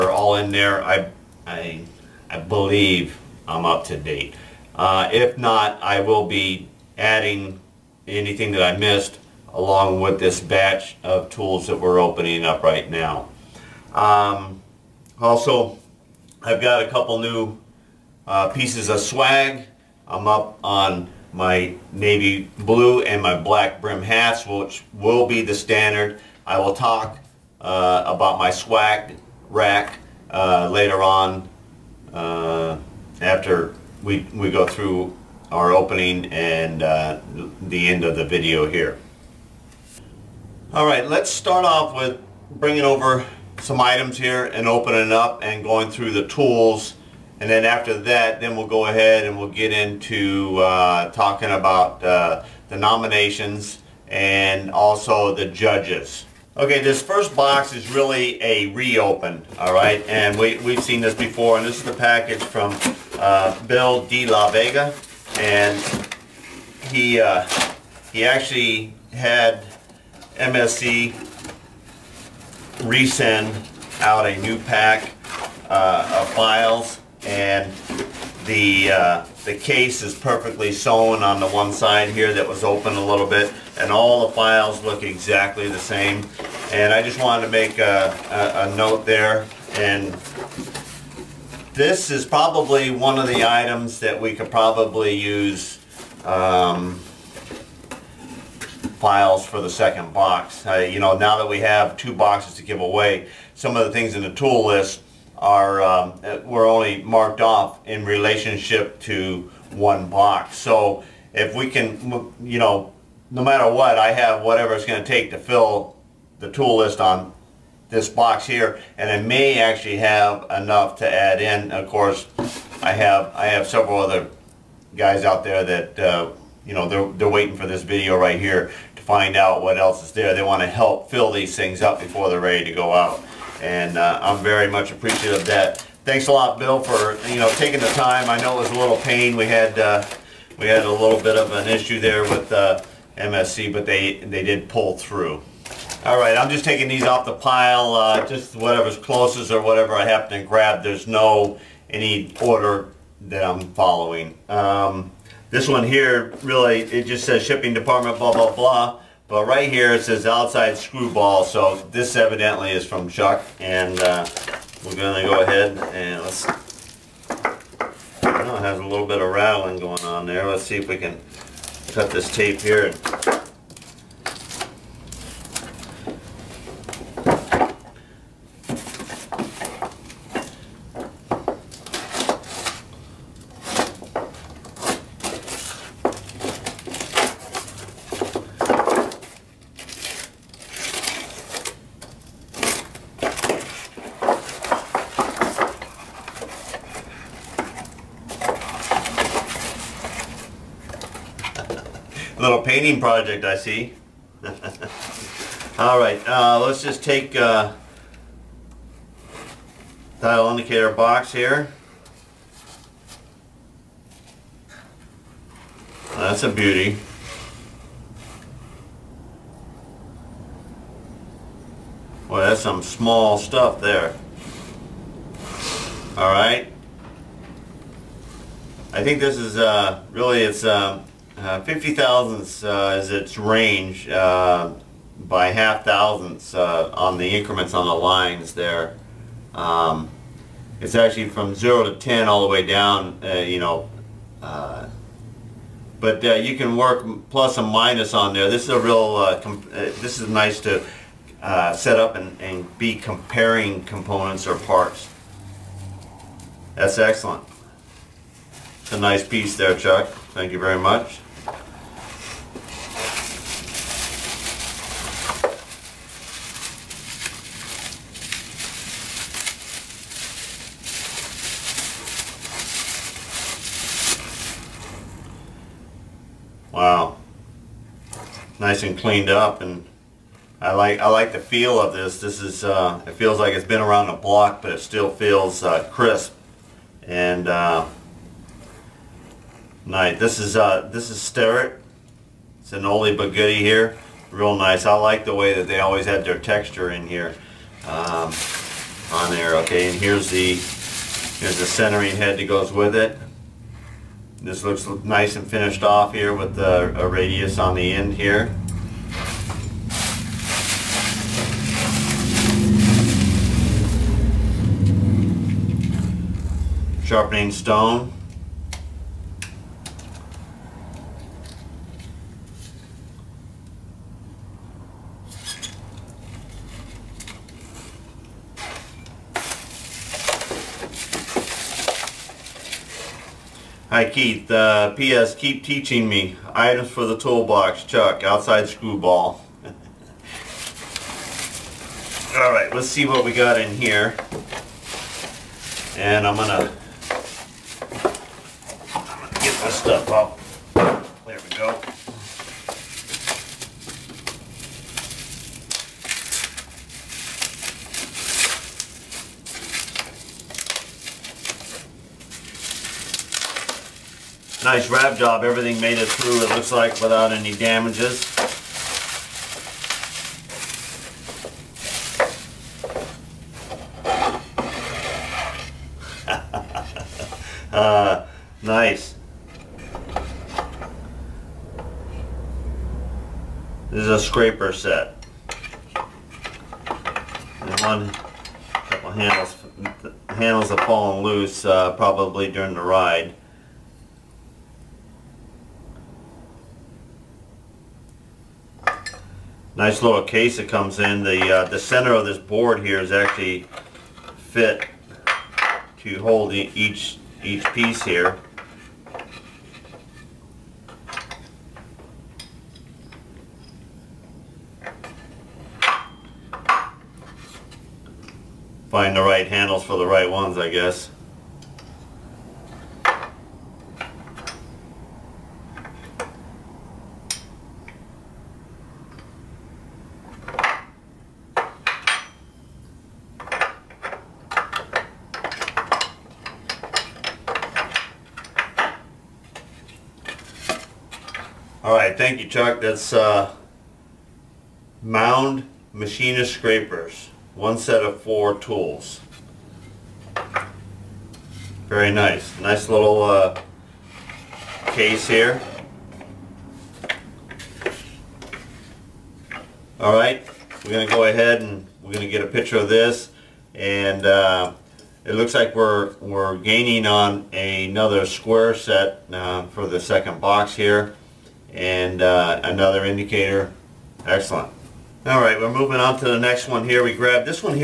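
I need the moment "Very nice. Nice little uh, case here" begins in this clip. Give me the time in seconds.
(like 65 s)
451 s.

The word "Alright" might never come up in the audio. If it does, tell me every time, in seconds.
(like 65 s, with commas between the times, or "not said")
40 s, 342 s.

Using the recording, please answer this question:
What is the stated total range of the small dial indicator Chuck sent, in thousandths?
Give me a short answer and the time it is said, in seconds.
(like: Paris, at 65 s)
50 thousandths, at 231 s.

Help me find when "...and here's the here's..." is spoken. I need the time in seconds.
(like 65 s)
299 s.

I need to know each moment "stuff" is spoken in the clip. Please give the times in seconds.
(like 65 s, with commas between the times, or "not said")
223 s, 349 s.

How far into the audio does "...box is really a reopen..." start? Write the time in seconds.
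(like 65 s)
57 s.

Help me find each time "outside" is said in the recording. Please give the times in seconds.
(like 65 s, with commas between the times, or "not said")
160 s, 338 s.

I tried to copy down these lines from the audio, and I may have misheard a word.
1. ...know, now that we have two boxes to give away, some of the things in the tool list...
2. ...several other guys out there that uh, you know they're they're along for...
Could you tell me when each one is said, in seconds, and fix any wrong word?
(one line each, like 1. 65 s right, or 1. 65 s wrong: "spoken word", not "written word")
1. 100 s right
2. 123 s wrong: "waiting", not "along".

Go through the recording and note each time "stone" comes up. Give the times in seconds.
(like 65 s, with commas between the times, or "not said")
317 s.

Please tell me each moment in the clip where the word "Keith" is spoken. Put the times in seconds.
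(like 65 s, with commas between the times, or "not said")
334 s.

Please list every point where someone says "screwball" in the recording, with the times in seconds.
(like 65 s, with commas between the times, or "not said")
160 s, 338 s.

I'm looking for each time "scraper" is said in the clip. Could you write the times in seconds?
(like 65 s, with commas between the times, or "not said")
384 s, 446 s.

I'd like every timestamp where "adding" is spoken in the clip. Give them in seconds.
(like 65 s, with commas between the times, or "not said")
6 s.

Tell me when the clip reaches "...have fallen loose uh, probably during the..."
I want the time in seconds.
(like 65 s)
390 s.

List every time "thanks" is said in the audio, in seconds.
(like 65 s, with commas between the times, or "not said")
136 s, 260 s, 442 s.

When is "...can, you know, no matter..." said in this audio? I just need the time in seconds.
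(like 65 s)
111 s.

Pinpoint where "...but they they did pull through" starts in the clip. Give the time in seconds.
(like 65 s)
143 s.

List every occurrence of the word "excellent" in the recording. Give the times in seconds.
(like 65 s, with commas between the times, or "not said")
256 s, 474 s.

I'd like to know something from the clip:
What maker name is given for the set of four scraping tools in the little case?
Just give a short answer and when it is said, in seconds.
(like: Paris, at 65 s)
Mound Machinist, at 445 s.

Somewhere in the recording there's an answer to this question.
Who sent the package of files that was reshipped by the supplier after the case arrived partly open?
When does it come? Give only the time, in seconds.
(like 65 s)
63 s.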